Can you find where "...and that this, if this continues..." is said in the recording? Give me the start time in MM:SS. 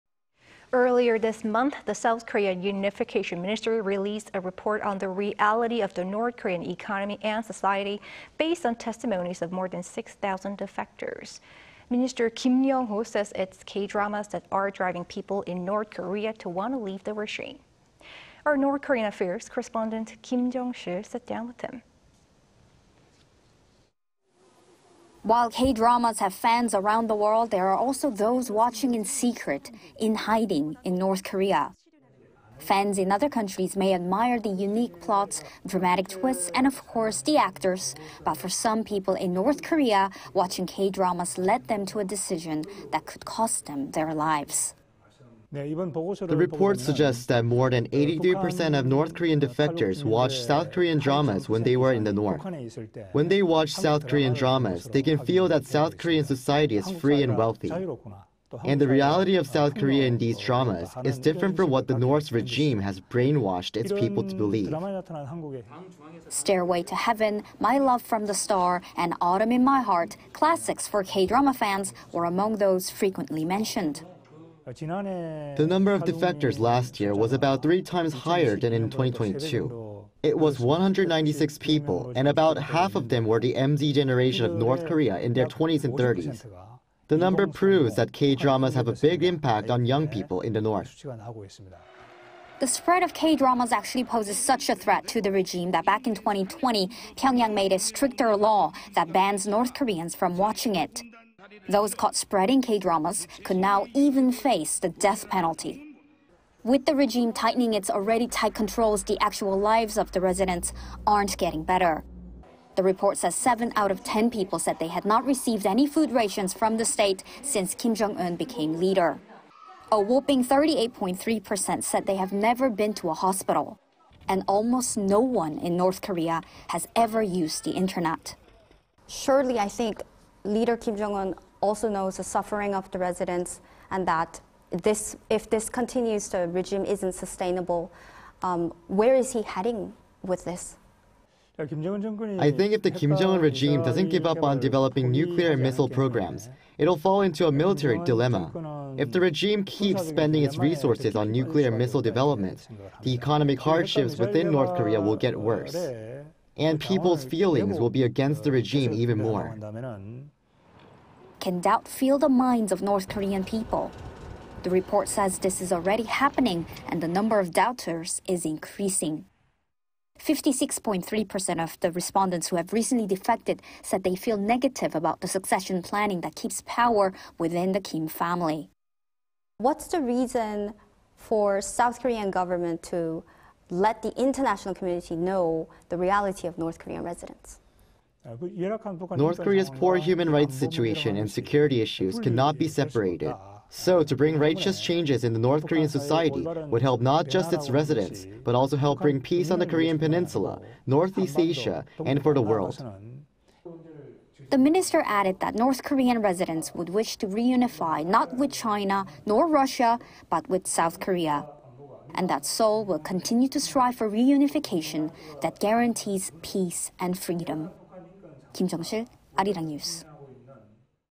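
02:13.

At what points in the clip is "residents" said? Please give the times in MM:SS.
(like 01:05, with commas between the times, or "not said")
01:50, 02:12, 03:07, 03:17, 03:26.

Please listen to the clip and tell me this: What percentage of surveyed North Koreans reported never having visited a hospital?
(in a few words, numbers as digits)
38.3%.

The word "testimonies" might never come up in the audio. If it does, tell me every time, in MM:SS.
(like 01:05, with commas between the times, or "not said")
00:08.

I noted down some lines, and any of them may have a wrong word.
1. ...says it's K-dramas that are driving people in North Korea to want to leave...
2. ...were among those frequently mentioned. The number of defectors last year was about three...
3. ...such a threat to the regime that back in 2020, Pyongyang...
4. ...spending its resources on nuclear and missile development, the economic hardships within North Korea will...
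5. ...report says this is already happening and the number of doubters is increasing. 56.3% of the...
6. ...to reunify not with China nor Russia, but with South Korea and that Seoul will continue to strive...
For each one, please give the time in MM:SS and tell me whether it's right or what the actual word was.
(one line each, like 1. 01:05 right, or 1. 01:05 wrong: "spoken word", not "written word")
1. 00:13 right
2. 01:12 right
3. 01:34 right
4. 02:30 right
5. 02:44 right
6. 03:27 right.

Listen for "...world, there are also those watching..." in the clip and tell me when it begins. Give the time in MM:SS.
00:27.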